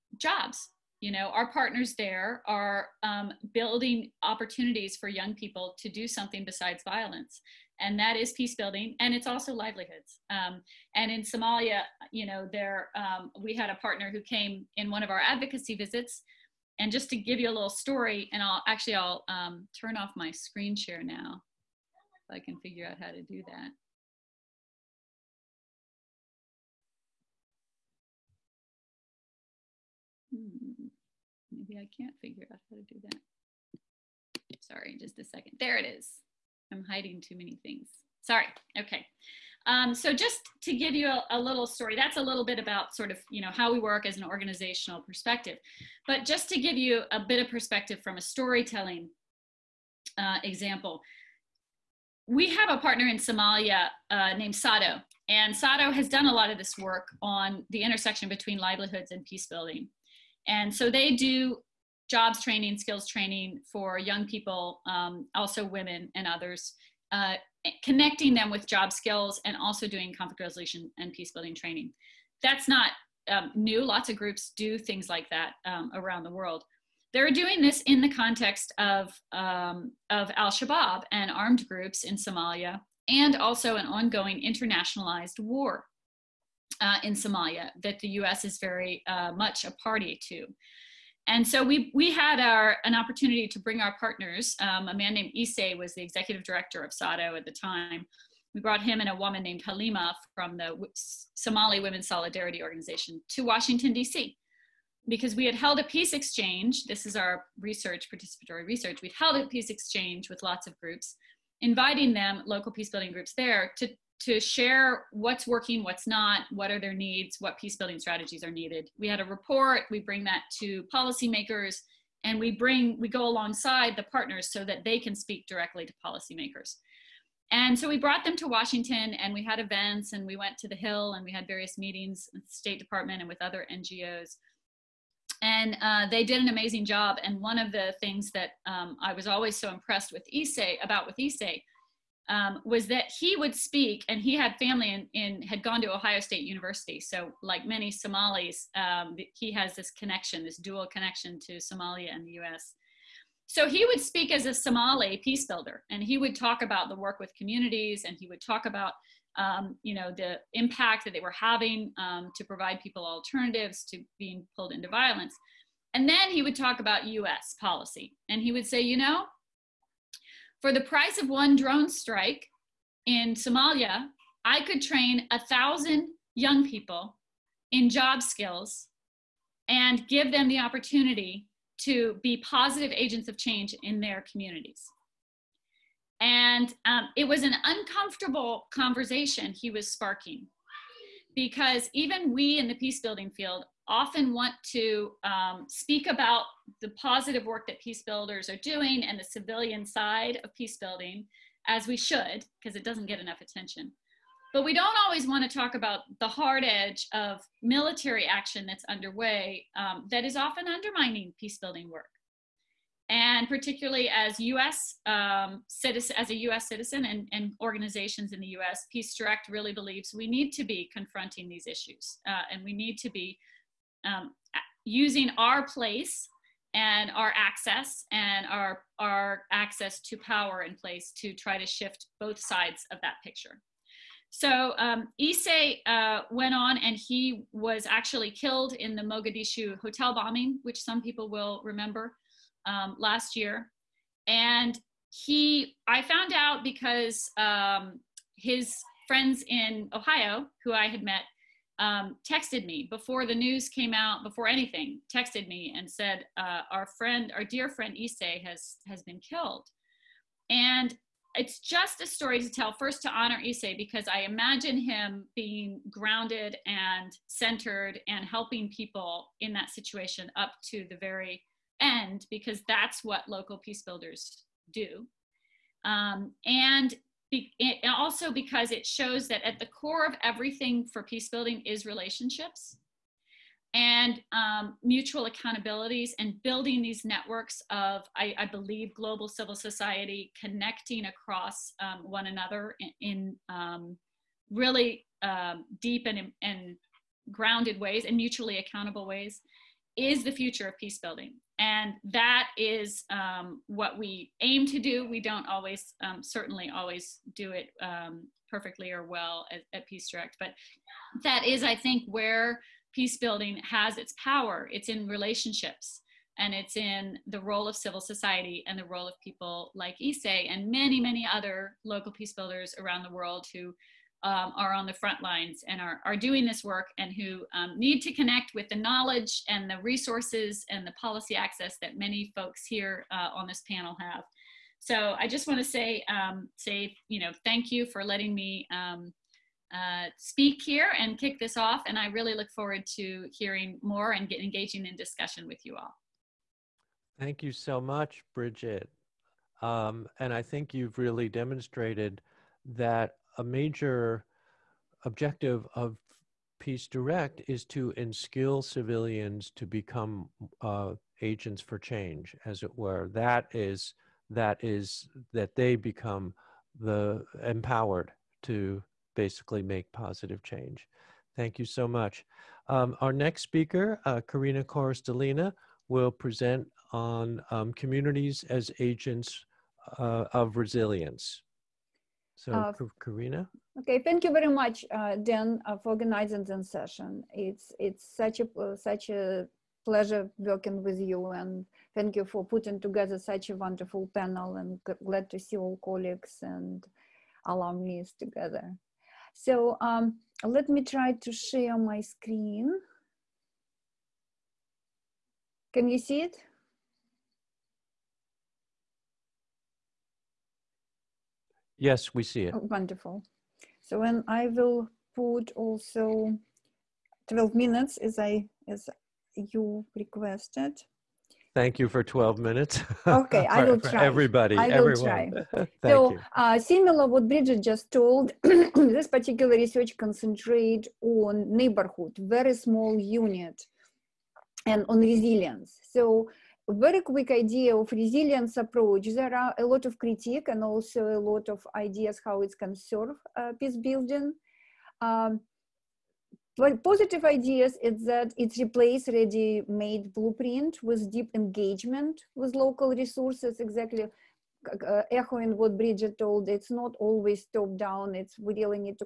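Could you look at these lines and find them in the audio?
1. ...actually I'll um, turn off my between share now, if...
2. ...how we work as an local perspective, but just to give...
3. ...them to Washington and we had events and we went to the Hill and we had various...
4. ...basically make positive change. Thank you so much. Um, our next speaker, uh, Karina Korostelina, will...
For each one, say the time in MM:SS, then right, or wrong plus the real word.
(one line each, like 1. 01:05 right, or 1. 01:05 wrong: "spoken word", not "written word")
1. 00:18 wrong: "screen", not "between"
2. 00:43 wrong: "organizational", not "local"
3. 02:08 right
4. 06:09 right.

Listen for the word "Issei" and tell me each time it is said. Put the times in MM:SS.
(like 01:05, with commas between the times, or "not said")
01:35, 03:55, 04:17, 04:23, 05:20.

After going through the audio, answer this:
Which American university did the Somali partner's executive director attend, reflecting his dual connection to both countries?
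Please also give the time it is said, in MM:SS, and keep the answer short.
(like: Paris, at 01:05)
Ohio State University, at 02:25.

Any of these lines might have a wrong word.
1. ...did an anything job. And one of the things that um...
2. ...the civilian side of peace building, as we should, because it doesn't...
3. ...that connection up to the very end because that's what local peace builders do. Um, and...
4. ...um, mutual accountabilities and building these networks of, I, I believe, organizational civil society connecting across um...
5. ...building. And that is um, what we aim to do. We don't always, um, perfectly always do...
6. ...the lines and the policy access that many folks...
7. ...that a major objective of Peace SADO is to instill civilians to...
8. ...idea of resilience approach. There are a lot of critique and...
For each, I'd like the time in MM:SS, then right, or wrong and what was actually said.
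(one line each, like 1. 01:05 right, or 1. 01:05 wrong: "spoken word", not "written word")
1. 02:16 wrong: "amazing", not "anything"
2. 03:19 right
3. 04:29 wrong: "situation", not "connection"
4. 04:44 wrong: "global", not "organizational"
5. 05:00 wrong: "certainly", not "perfectly"
6. 05:29 wrong: "resources", not "lines"
7. 05:52 wrong: "Direct", not "SADO"
8. 07:17 right.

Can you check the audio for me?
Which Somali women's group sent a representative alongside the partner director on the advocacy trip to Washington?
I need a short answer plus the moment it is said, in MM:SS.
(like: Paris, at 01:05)
Somali Women's Solidarity Organization, at 01:41.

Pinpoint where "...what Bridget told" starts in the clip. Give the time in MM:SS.
07:35.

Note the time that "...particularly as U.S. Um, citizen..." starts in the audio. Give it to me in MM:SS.
03:33.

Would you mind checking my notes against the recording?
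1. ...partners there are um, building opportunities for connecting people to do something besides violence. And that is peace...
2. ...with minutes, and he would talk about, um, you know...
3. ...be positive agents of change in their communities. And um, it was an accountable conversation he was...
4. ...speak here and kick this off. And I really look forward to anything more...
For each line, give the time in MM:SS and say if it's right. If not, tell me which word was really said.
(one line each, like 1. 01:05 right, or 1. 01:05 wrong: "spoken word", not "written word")
1. 00:01 wrong: "young", not "connecting"
2. 02:37 wrong: "communities", not "minutes"
3. 03:02 wrong: "uncomfortable", not "accountable"
4. 05:40 wrong: "hearing", not "anything".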